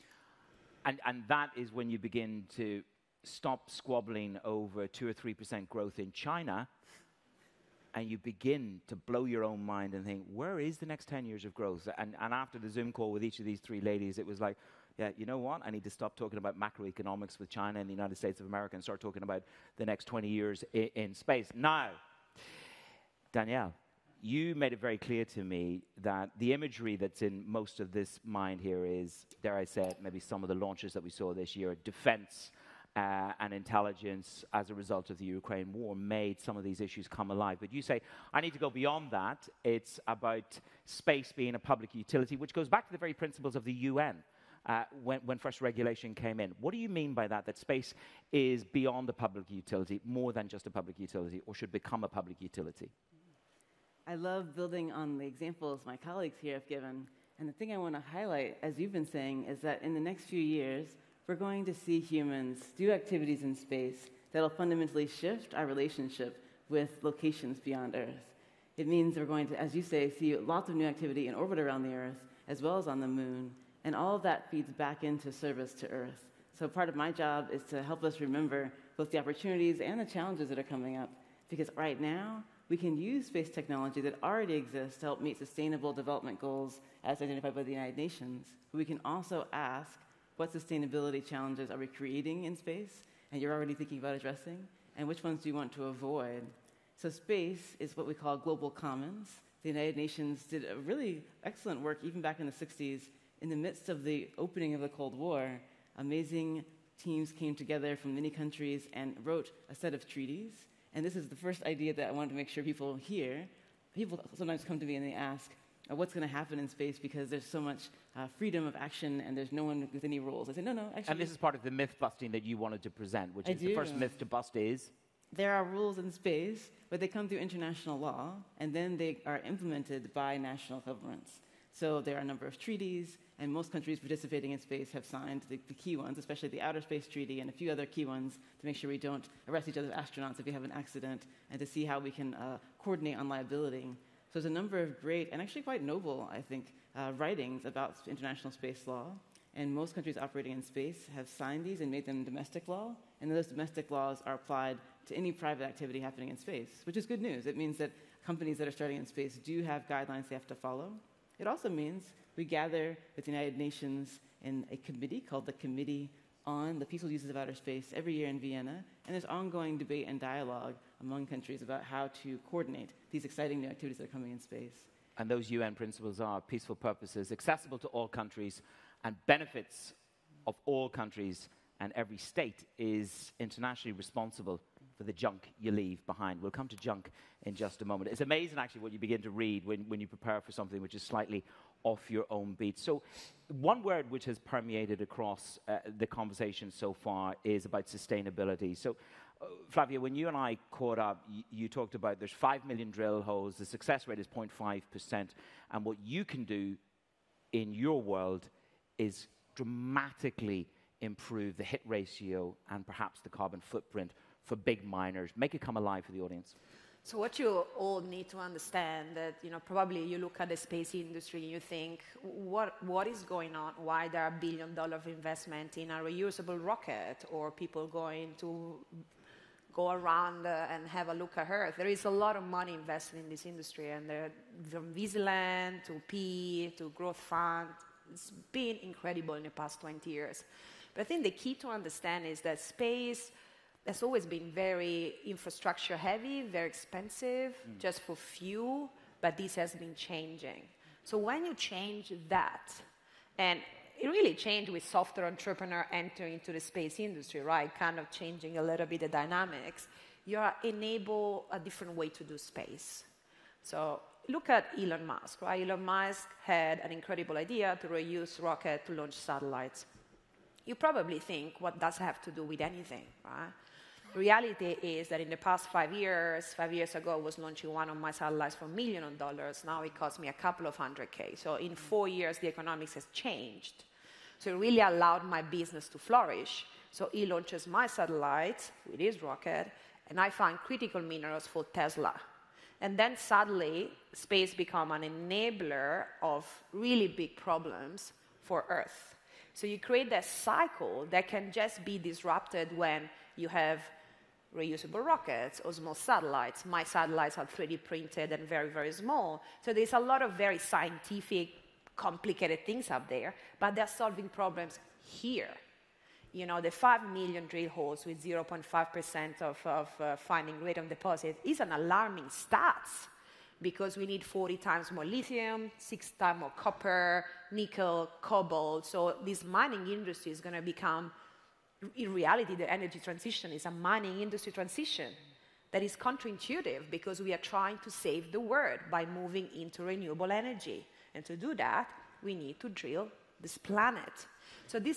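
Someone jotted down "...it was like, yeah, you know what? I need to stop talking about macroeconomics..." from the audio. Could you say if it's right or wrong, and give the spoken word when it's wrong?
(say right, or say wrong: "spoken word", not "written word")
right.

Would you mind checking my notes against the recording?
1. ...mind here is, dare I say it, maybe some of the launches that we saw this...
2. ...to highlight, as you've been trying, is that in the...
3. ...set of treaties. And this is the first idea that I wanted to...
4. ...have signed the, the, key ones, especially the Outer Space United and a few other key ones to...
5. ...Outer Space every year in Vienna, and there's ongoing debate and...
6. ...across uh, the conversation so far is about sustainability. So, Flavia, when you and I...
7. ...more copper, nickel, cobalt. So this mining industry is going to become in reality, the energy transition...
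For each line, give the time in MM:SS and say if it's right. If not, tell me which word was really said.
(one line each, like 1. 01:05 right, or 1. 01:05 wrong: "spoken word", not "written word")
1. 00:28 right
2. 00:57 wrong: "saying", not "trying"
3. 01:49 right
4. 02:14 wrong: "Treaty", not "United"
5. 02:47 right
6. 03:15 right
7. 05:26 right.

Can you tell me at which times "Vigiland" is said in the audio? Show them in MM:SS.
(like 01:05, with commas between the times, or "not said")
03:54.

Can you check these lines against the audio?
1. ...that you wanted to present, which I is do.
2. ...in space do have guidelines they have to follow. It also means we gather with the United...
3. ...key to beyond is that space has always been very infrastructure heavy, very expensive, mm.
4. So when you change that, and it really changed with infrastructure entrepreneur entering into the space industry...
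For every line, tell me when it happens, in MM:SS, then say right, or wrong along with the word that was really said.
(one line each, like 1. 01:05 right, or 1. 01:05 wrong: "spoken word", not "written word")
1. 02:02 right
2. 02:38 right
3. 04:01 wrong: "understand", not "beyond"
4. 04:11 wrong: "software", not "infrastructure".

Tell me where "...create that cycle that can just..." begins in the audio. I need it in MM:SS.
04:59.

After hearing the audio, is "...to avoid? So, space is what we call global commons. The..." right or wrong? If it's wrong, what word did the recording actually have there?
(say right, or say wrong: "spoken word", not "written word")
right.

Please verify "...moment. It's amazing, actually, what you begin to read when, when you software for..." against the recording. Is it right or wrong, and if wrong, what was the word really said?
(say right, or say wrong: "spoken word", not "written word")
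wrong: "prepare", not "software".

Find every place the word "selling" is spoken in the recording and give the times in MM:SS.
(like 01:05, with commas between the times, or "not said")
not said.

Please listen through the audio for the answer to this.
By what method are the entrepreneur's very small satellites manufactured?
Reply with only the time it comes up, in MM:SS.
05:07.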